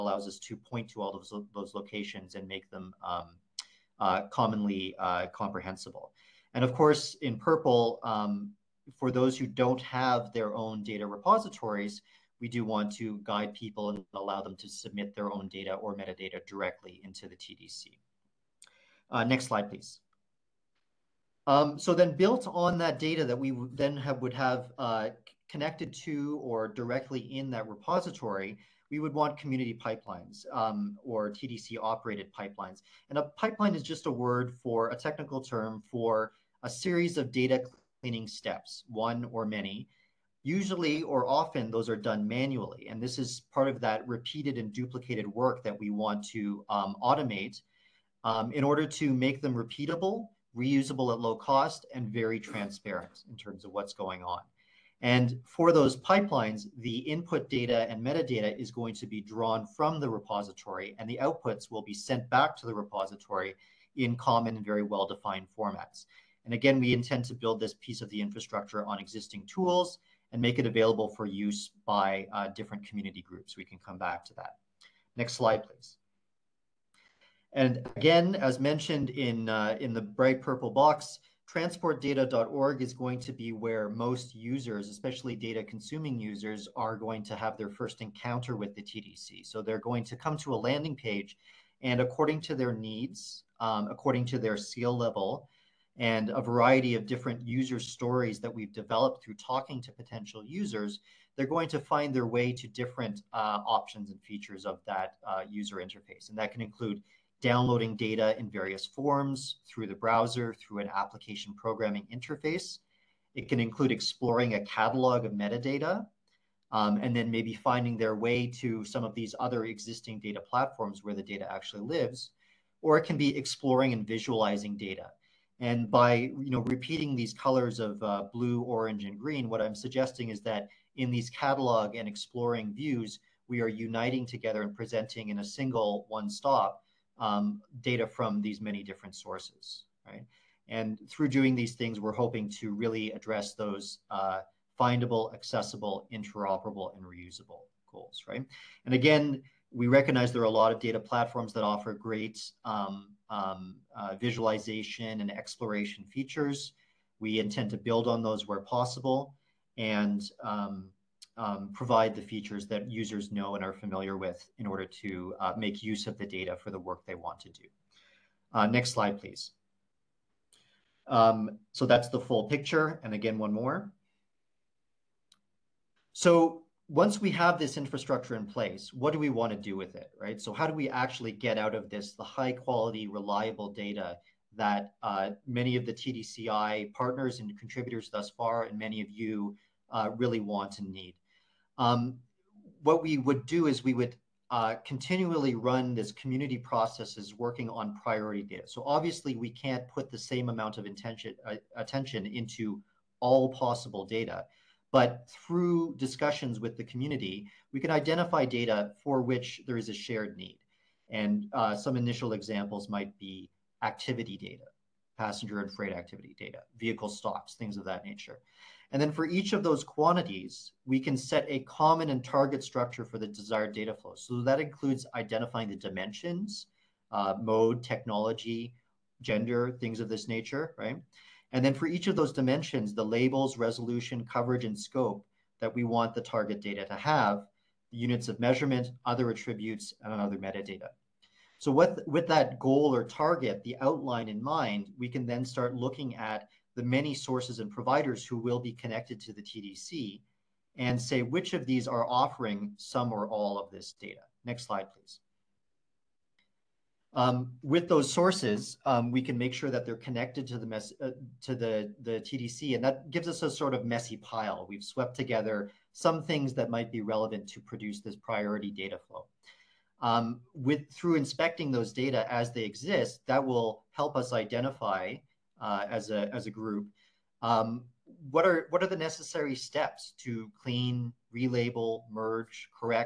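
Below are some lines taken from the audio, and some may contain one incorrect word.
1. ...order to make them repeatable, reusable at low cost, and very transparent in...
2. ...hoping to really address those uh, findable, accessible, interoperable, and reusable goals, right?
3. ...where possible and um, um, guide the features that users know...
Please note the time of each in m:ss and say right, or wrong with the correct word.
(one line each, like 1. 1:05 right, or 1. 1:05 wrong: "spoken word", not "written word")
1. 0:48 right
2. 2:22 right
3. 2:38 wrong: "provide", not "guide".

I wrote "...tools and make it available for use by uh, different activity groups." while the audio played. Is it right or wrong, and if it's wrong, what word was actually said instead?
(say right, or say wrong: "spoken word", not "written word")
wrong: "community", not "activity".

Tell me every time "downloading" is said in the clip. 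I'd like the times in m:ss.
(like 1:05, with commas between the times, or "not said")
1:47.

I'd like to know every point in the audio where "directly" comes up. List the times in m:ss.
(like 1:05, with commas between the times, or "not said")
0:16, 0:26.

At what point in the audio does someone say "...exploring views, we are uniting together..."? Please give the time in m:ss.
2:12.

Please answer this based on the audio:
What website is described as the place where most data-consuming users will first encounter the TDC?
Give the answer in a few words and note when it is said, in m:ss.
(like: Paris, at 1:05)
transportdata.org, at 1:21.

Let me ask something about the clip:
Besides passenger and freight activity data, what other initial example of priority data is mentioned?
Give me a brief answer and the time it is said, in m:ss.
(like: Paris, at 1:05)
Vehicle stops, at 3:36.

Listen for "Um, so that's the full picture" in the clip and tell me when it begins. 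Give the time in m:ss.
2:51.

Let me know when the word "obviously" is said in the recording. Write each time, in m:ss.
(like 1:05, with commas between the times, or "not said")
3:18.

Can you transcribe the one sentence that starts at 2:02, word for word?
Or it can be exploring and visualizing data.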